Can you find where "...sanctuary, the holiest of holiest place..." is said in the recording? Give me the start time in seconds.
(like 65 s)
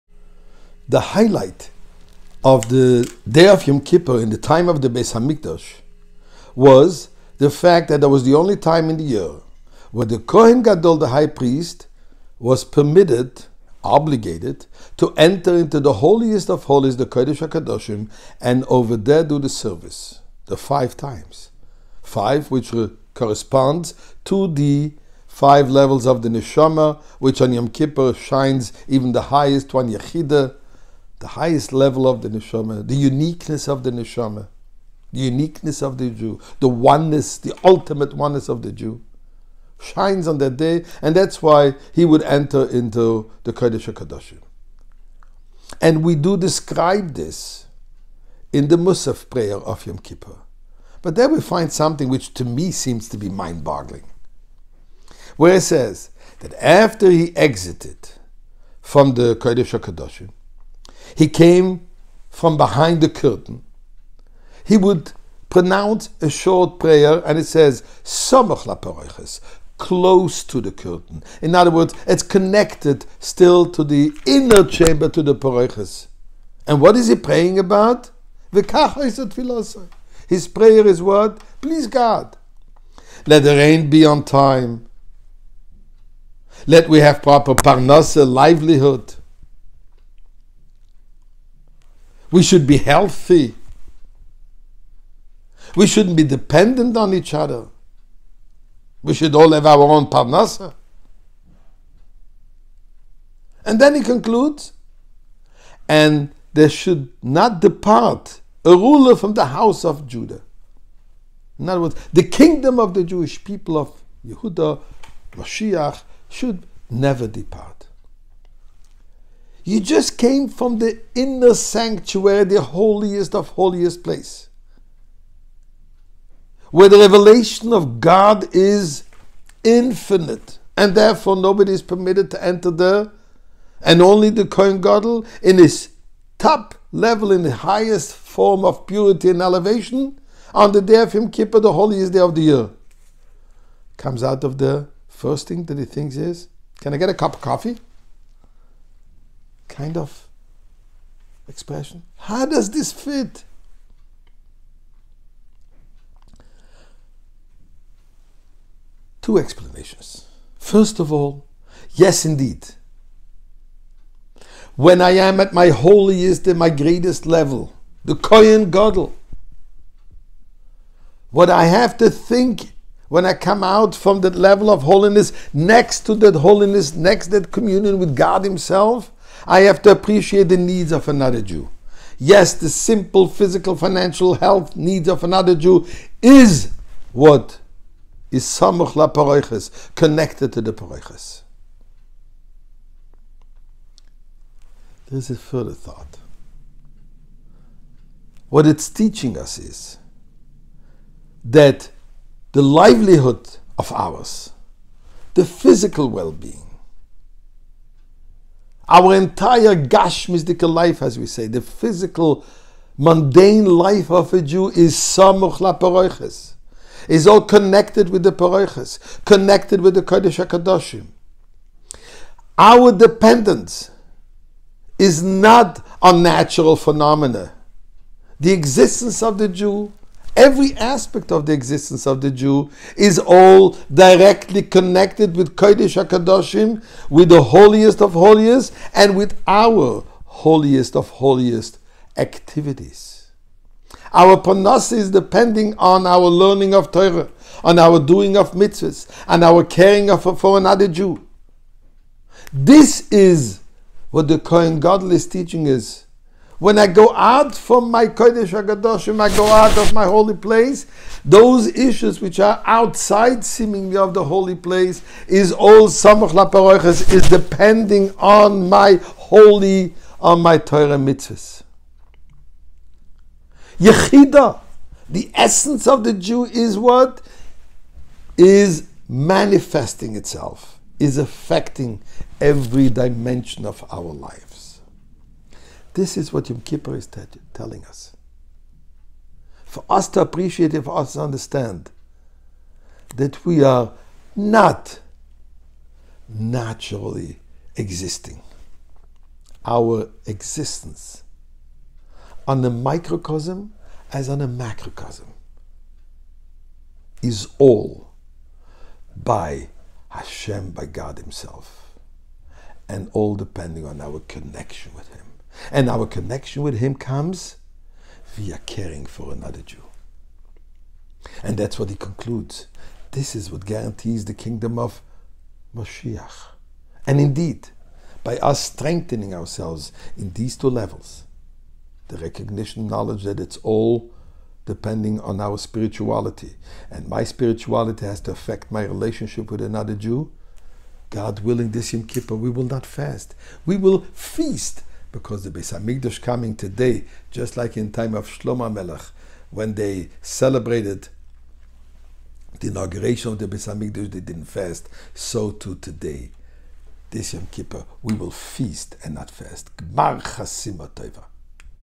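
121 s.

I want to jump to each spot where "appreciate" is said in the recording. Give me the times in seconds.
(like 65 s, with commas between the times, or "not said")
179 s, 290 s.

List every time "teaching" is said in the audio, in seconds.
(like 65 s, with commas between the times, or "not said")
198 s, 255 s.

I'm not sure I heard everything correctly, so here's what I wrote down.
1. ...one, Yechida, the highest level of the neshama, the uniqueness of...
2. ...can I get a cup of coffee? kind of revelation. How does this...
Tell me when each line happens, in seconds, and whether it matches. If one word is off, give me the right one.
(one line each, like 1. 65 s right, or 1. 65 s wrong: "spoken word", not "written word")
1. 29 s right
2. 146 s wrong: "expression", not "revelation".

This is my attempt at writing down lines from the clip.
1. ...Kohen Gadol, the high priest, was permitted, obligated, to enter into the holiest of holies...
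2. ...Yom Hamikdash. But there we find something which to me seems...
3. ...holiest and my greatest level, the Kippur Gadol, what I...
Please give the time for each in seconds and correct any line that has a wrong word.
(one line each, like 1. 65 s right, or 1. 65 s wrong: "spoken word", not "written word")
1. 10 s right
2. 49 s wrong: "Kippur", not "Hamikdash"
3. 165 s wrong: "Kohen", not "Kippur".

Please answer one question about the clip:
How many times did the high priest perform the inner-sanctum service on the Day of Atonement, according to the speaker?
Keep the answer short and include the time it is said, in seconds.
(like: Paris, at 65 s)
5, at 20 s.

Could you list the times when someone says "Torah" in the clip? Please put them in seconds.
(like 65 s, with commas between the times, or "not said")
246 s, 270 s.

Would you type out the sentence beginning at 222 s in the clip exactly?
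Our dependence is not on natural phenomena.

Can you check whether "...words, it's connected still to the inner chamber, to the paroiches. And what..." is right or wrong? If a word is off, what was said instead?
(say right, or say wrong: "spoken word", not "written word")
right.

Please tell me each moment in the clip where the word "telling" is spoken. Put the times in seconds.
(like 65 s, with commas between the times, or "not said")
287 s.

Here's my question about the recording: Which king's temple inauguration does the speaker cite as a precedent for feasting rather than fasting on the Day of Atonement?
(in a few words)
Shlomo Melech.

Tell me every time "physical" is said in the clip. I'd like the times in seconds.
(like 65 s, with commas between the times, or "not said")
183 s, 205 s, 211 s.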